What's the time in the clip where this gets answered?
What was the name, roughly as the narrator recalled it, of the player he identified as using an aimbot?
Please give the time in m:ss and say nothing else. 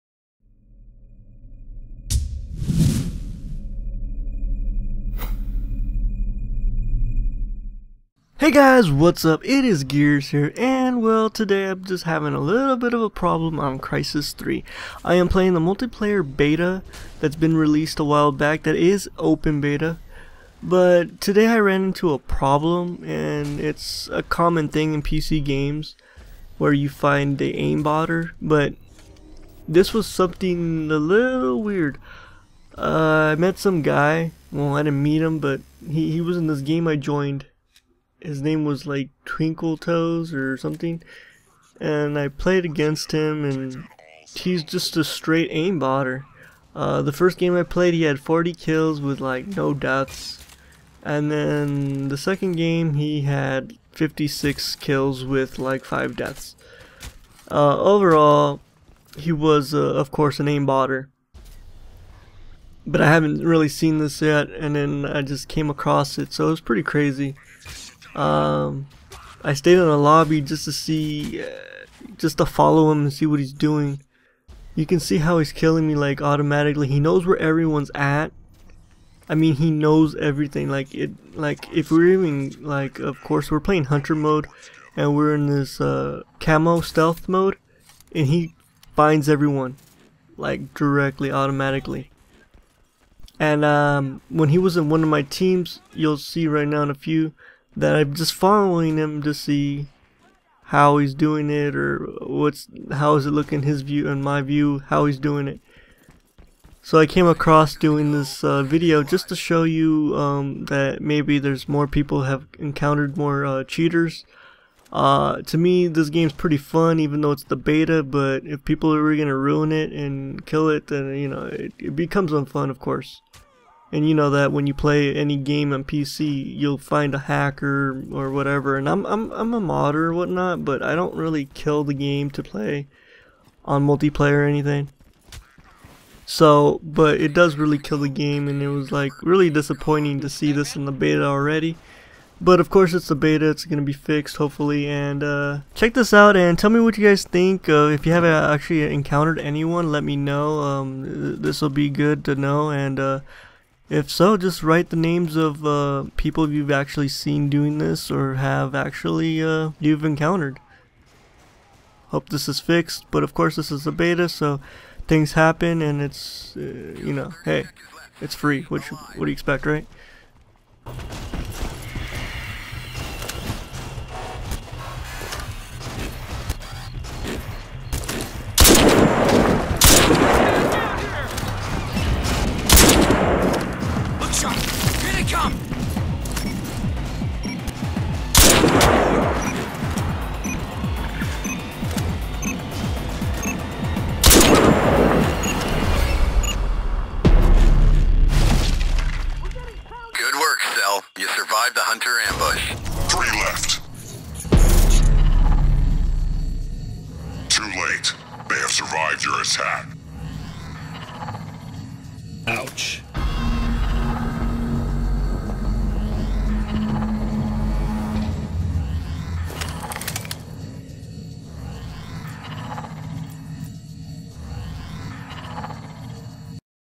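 0:39.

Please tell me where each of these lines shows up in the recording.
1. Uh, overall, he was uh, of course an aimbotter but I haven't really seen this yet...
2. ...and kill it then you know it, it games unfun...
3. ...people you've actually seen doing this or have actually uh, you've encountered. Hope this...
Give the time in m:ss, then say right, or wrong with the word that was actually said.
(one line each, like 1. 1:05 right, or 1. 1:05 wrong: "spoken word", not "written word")
1. 0:57 right
2. 1:59 wrong: "becomes", not "games"
3. 2:36 right.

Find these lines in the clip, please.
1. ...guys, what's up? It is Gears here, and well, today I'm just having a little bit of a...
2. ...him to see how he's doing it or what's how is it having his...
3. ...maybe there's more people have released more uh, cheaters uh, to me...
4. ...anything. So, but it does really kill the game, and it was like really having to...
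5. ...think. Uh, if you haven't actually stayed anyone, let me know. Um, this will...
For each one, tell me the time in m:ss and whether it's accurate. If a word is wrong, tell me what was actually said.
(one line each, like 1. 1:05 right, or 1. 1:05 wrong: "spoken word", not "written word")
1. 0:08 right
2. 1:38 wrong: "looking", not "having"
3. 1:51 wrong: "encountered", not "released"
4. 2:14 wrong: "disappointing", not "having"
5. 2:27 wrong: "encountered", not "stayed".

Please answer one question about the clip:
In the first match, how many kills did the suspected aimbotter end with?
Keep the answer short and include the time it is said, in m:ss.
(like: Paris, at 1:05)
40, at 0:48.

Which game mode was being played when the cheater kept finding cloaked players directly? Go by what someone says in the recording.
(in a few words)
hunter mode.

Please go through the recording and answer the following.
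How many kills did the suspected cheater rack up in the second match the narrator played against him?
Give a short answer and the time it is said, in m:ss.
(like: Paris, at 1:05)
56, at 0:53.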